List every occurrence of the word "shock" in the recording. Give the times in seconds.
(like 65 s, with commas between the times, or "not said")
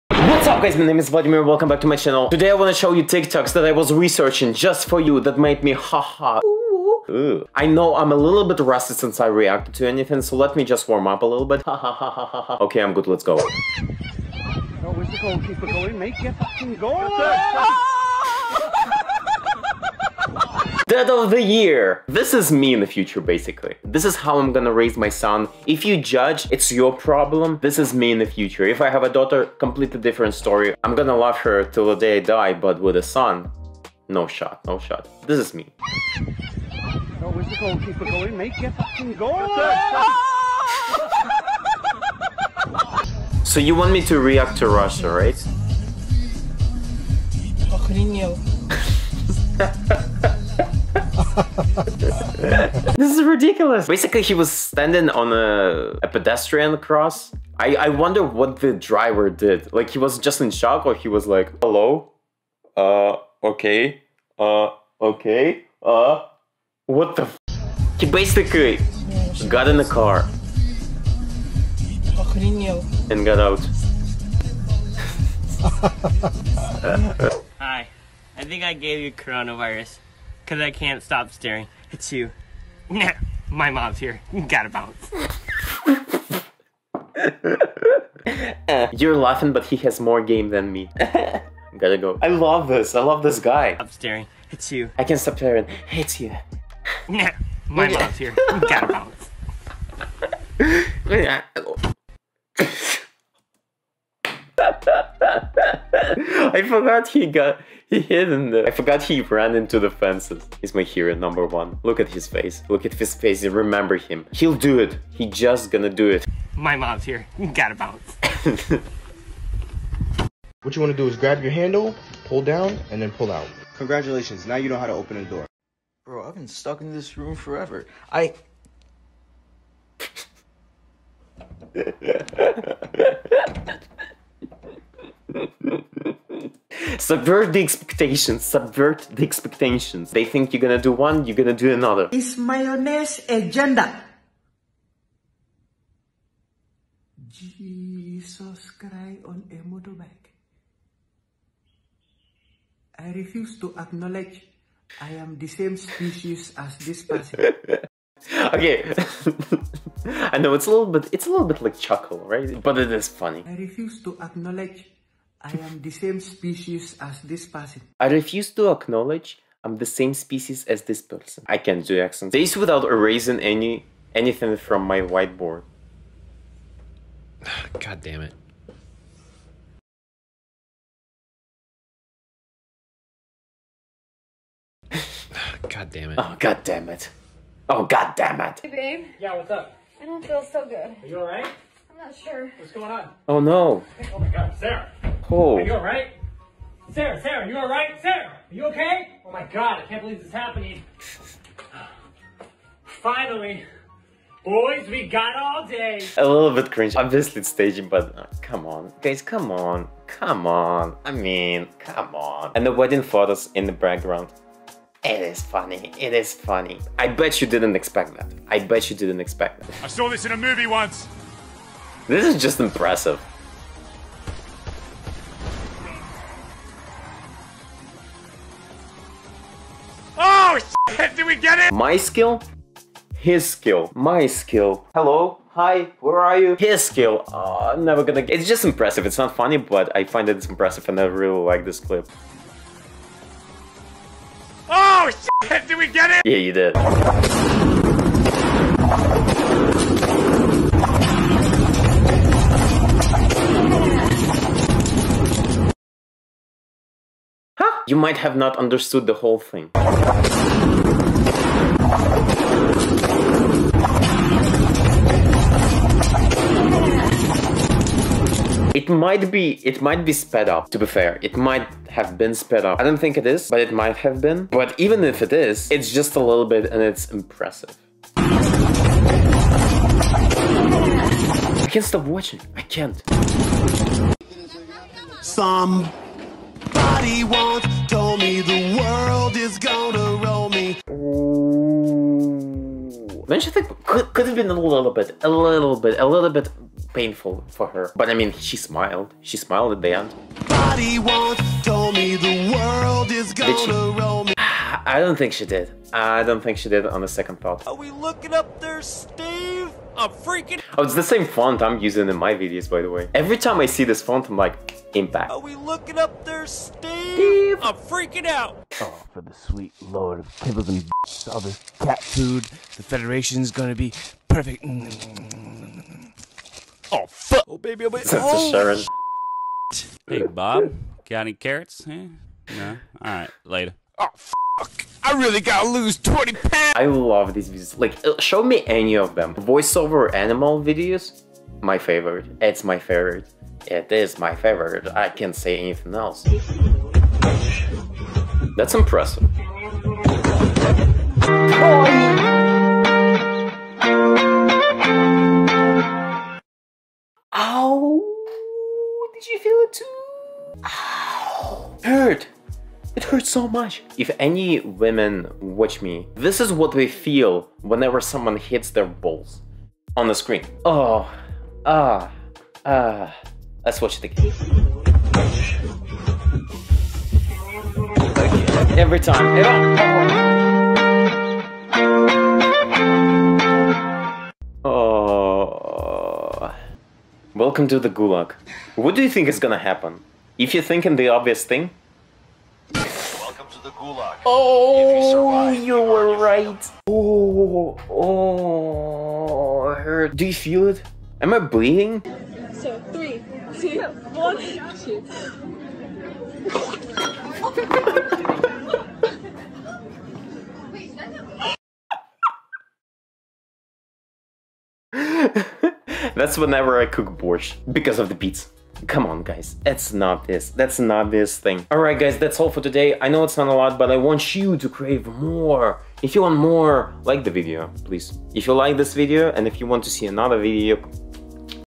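60 s.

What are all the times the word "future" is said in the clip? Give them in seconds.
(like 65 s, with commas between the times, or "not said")
22 s, 28 s.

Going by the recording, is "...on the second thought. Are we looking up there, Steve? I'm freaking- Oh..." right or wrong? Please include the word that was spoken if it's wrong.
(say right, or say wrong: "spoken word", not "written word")
right.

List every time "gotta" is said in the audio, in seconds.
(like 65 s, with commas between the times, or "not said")
84 s, 91 s, 98 s, 117 s, 335 s.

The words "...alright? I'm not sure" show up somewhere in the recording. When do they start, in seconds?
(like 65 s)
191 s.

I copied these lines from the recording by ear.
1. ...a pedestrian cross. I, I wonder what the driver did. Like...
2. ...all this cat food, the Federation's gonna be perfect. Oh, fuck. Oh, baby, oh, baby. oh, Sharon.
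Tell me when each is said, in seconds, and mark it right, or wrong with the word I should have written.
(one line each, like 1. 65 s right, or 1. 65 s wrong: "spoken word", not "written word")
1. 56 s right
2. 321 s right.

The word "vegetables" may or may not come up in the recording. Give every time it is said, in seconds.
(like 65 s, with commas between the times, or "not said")
not said.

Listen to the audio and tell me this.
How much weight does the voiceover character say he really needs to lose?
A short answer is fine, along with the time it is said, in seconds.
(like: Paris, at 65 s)
20 pounds, at 335 s.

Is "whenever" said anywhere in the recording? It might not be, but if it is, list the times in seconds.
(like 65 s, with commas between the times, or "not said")
367 s, 416 s.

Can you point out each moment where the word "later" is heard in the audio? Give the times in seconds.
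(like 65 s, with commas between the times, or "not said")
333 s.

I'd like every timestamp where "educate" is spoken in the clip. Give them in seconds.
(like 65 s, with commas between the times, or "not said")
not said.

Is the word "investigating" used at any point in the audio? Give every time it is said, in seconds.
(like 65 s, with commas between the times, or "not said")
not said.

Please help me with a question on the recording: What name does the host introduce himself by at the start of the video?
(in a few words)
Vladimir.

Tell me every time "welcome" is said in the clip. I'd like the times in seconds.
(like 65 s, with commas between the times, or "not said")
1 s, 387 s.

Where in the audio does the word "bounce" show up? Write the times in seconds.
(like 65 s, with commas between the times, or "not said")
84 s, 98 s, 117 s.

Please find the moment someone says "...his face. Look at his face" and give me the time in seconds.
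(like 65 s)
112 s.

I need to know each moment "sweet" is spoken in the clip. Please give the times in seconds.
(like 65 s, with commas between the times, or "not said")
319 s.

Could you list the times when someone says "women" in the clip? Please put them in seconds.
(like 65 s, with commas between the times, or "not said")
364 s.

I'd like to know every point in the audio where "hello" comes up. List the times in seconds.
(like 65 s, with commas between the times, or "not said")
61 s, 234 s.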